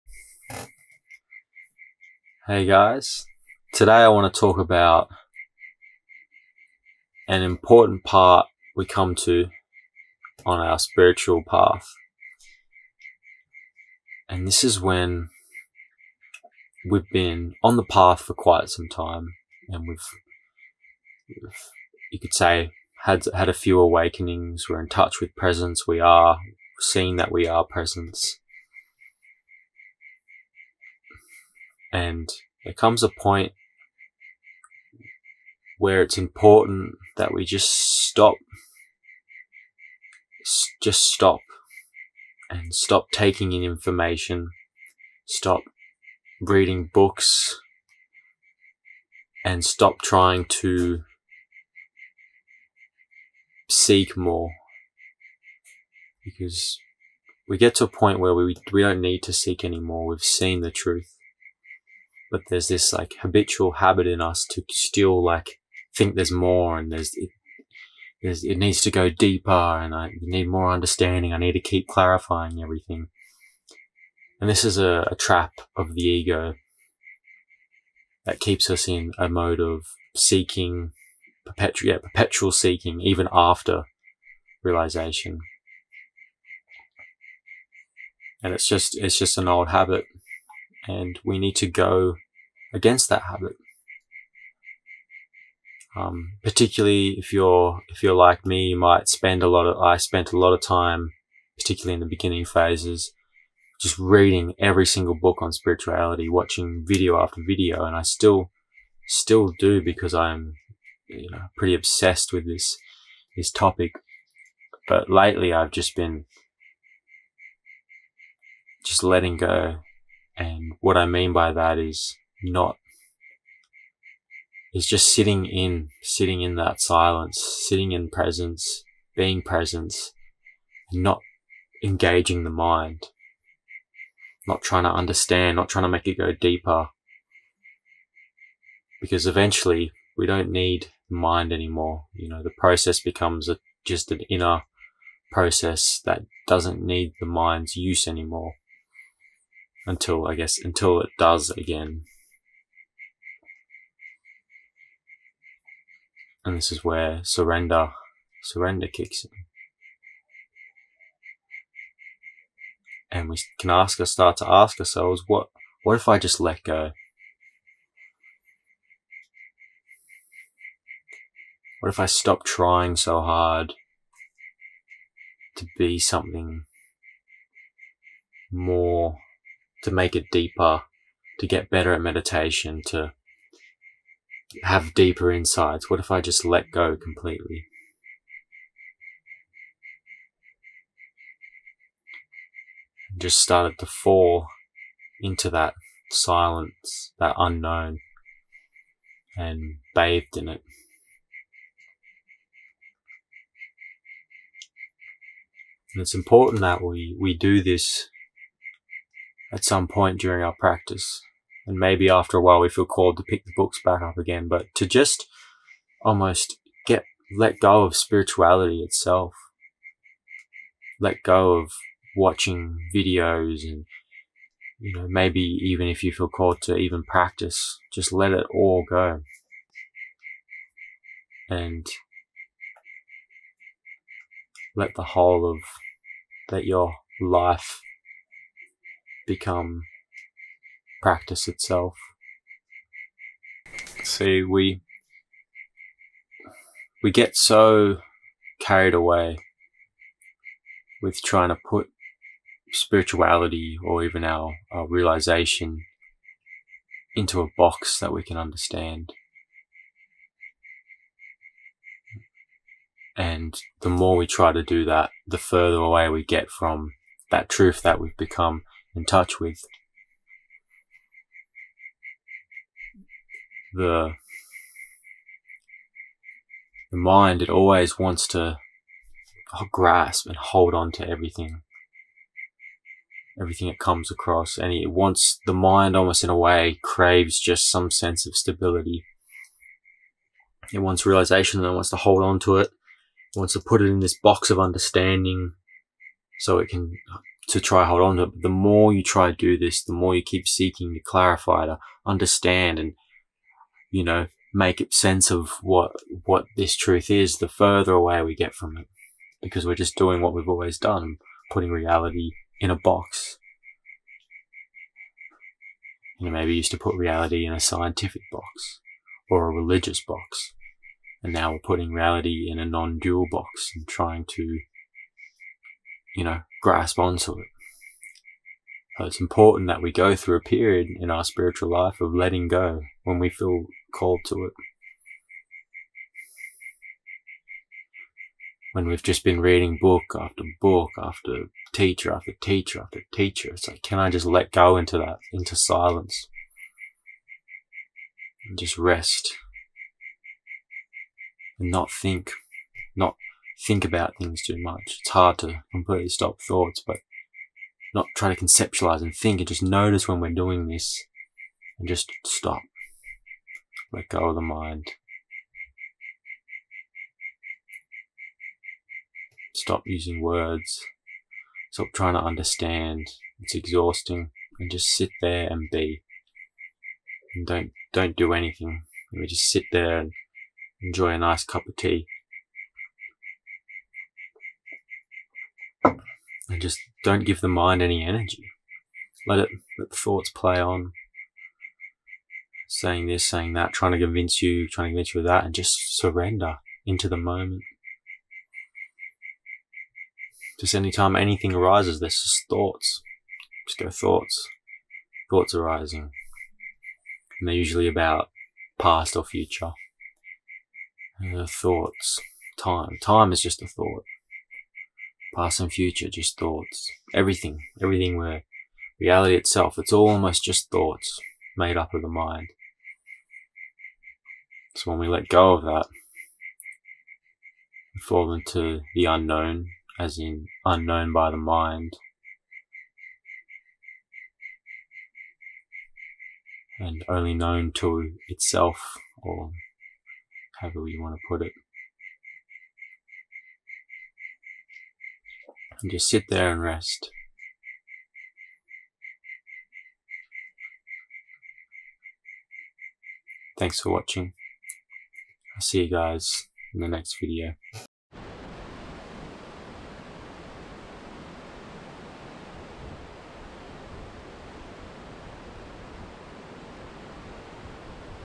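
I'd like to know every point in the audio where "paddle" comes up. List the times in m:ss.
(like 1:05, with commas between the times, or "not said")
not said.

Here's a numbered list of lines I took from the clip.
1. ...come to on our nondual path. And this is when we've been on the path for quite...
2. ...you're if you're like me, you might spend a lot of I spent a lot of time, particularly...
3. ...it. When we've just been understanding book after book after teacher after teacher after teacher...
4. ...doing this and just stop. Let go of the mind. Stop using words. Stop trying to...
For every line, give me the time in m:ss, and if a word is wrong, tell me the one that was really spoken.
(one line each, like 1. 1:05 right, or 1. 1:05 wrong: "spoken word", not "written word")
1. 0:08 wrong: "spiritual", not "nondual"
2. 1:37 right
3. 5:34 wrong: "reading", not "understanding"
4. 6:00 right.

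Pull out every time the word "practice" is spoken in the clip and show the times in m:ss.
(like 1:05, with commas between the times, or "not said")
3:30, 3:47, 4:01.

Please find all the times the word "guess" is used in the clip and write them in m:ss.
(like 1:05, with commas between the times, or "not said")
2:30.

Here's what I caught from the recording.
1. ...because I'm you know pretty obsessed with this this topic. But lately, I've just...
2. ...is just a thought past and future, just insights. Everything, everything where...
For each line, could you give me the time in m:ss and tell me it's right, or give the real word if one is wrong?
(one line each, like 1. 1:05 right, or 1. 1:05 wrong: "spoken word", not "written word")
1. 1:49 right
2. 6:53 wrong: "thoughts", not "insights".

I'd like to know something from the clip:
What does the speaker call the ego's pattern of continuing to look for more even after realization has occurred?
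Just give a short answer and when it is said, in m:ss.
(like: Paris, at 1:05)
perpetual seeking, at 1:21.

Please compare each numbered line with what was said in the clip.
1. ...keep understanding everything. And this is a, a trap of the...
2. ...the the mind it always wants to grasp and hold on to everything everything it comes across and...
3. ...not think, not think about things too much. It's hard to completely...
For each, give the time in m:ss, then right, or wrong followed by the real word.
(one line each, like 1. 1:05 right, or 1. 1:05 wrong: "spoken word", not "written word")
1. 1:11 wrong: "clarifying", not "understanding"
2. 4:33 right
3. 5:51 right.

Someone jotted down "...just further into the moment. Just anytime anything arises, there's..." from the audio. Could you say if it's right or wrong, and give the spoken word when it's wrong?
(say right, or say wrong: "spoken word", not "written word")
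wrong: "surrender", not "further".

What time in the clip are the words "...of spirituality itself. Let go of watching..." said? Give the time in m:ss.
3:37.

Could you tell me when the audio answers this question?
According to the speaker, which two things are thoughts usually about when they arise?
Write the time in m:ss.
6:48.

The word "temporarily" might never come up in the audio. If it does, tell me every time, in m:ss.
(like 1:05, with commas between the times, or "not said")
not said.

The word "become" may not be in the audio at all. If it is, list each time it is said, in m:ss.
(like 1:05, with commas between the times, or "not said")
2:22, 3:59, 4:28.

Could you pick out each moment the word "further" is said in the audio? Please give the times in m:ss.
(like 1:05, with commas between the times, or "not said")
4:25, 5:07.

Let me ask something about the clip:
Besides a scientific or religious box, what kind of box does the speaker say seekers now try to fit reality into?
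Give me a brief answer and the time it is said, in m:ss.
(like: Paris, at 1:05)
non-dual box, at 5:22.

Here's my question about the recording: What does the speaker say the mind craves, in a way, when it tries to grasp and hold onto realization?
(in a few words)
stability.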